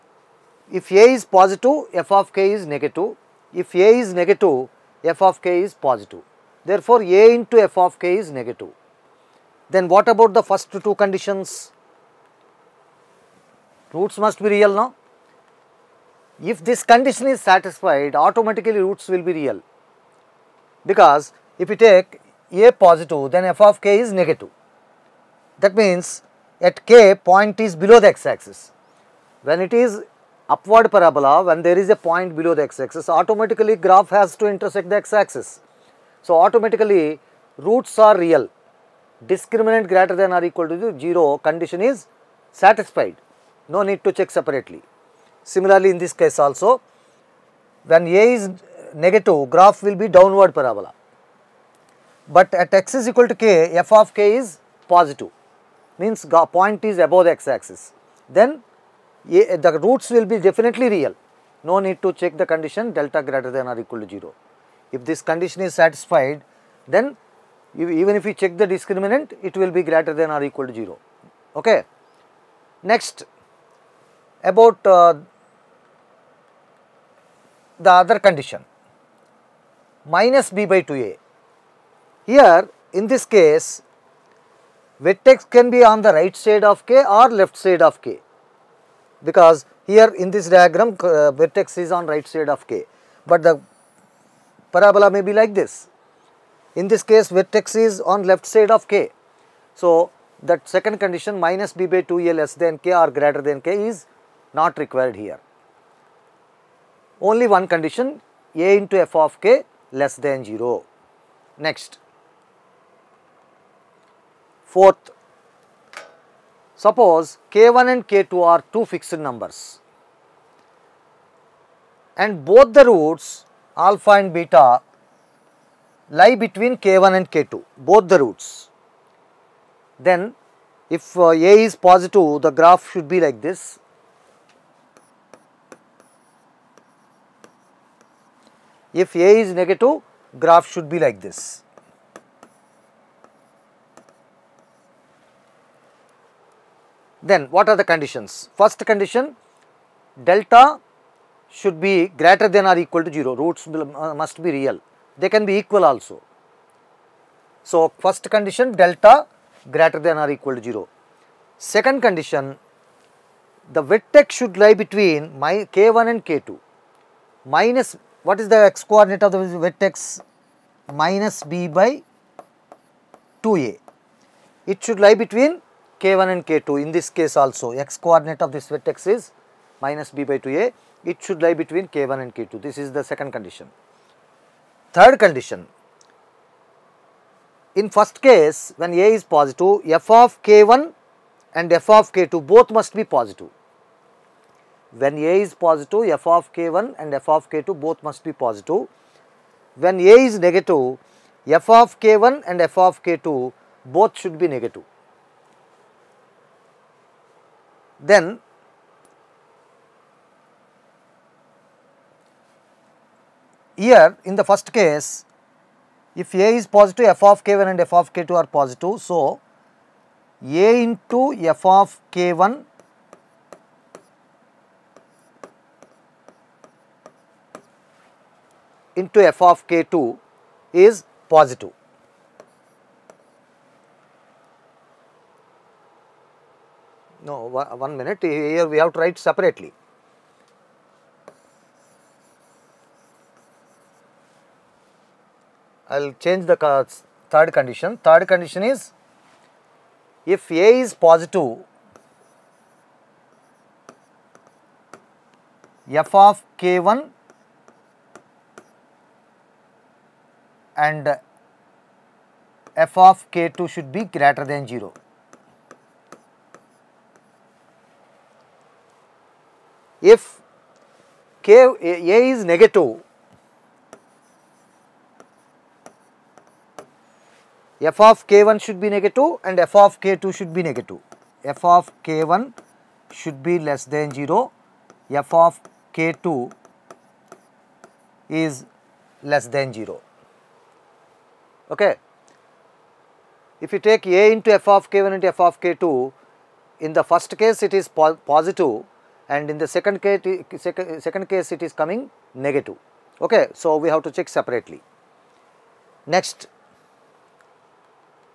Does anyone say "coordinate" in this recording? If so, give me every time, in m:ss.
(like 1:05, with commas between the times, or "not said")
2:48, 2:58.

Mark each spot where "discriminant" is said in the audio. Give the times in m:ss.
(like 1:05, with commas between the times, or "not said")
0:39, 1:08.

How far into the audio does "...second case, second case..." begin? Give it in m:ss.
4:59.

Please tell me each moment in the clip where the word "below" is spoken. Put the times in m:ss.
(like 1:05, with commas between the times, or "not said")
0:27, 0:32.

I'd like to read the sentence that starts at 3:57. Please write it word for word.
No, one minute, here we have to write separately.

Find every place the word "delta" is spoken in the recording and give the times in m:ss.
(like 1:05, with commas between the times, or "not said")
1:02, 2:30, 2:38.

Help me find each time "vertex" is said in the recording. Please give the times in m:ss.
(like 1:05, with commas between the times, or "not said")
1:24, 1:31, 1:37, 2:43, 2:49, 2:58.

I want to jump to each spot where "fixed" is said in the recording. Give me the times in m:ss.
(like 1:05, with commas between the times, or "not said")
1:58.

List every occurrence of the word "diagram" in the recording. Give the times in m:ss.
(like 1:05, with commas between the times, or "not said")
1:30.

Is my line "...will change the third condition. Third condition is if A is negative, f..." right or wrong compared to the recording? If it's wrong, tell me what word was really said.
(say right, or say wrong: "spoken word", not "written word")
wrong: "positive", not "negative".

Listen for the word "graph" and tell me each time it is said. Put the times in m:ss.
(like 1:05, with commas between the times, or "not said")
0:33, 0:49, 2:12, 2:20.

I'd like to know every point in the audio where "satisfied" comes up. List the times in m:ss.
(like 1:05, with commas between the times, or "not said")
0:17, 0:42, 1:05.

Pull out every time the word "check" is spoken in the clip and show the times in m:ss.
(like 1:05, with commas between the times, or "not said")
0:44, 1:02, 1:08, 5:04.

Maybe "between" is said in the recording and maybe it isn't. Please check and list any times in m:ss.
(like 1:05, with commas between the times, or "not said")
2:06, 2:44, 2:55, 3:01.